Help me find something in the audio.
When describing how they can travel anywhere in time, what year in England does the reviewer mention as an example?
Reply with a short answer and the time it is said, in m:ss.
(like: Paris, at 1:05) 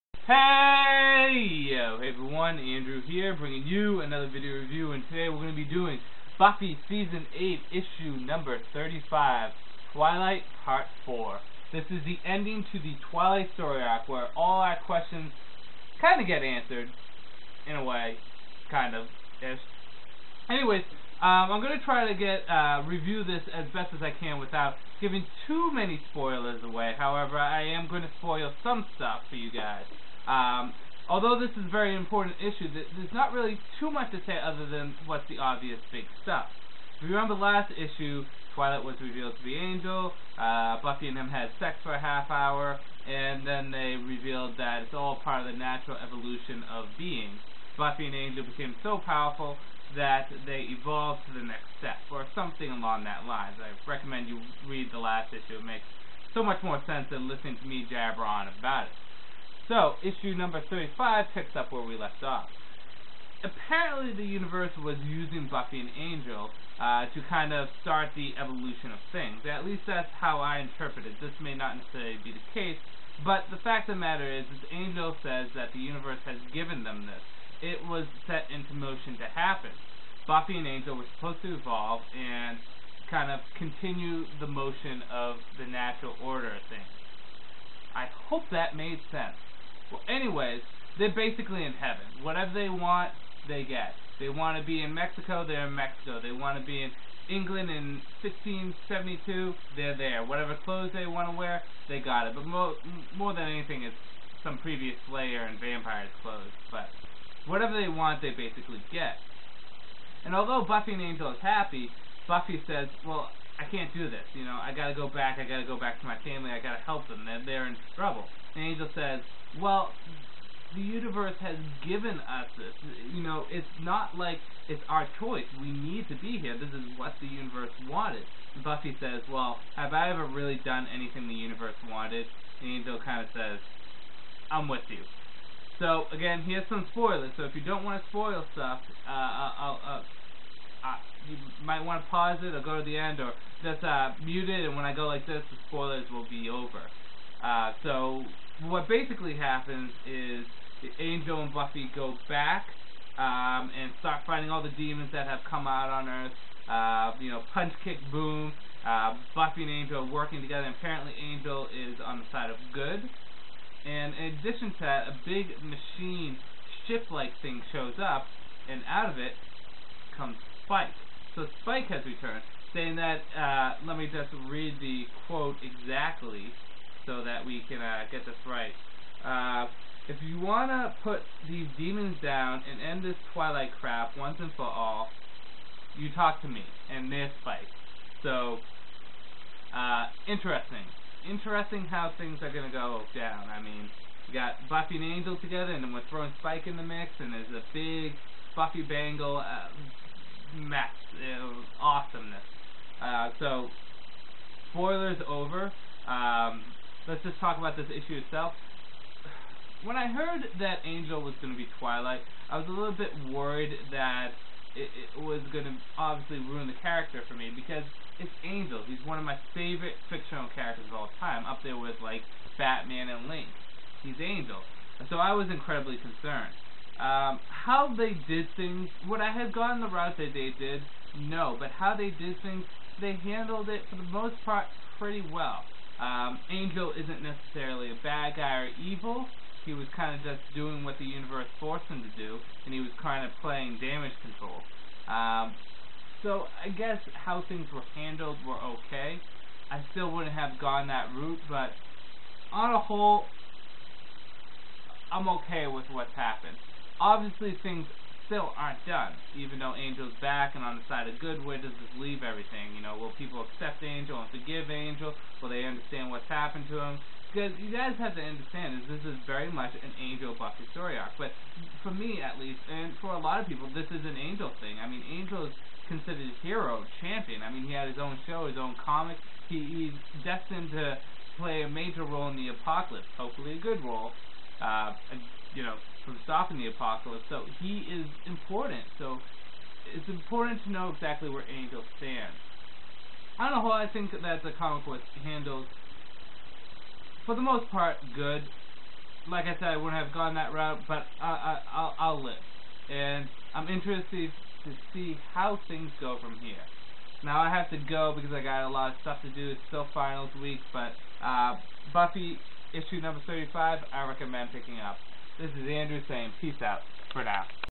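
1672, at 1:38.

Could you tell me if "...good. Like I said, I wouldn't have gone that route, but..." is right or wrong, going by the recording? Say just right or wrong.
right.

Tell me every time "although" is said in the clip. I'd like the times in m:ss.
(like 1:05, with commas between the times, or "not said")
0:31, 1:50.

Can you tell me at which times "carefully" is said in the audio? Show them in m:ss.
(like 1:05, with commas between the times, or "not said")
not said.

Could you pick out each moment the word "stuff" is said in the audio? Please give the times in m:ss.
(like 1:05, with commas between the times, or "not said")
0:28, 0:36, 2:18, 5:09.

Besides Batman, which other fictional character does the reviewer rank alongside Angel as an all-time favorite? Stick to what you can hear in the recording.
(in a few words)
Link.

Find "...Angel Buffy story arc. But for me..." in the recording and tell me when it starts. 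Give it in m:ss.
4:29.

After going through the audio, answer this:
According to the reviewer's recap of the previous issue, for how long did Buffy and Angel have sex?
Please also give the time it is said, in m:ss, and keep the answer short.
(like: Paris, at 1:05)
half hour, at 0:41.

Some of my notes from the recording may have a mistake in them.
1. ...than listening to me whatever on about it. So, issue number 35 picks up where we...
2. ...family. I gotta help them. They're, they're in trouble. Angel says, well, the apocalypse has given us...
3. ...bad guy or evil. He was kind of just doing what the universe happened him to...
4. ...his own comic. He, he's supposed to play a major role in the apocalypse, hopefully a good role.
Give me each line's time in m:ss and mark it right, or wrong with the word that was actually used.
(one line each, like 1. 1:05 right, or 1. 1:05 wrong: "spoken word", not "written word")
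1. 0:57 wrong: "jabber", not "whatever"
2. 1:56 wrong: "universe", not "apocalypse"
3. 3:58 wrong: "forced", not "happened"
4. 4:38 wrong: "destined", not "supposed".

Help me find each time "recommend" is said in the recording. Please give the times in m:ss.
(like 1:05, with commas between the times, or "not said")
0:53, 5:14.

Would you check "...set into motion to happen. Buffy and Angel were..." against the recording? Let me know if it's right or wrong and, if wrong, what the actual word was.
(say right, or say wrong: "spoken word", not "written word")
right.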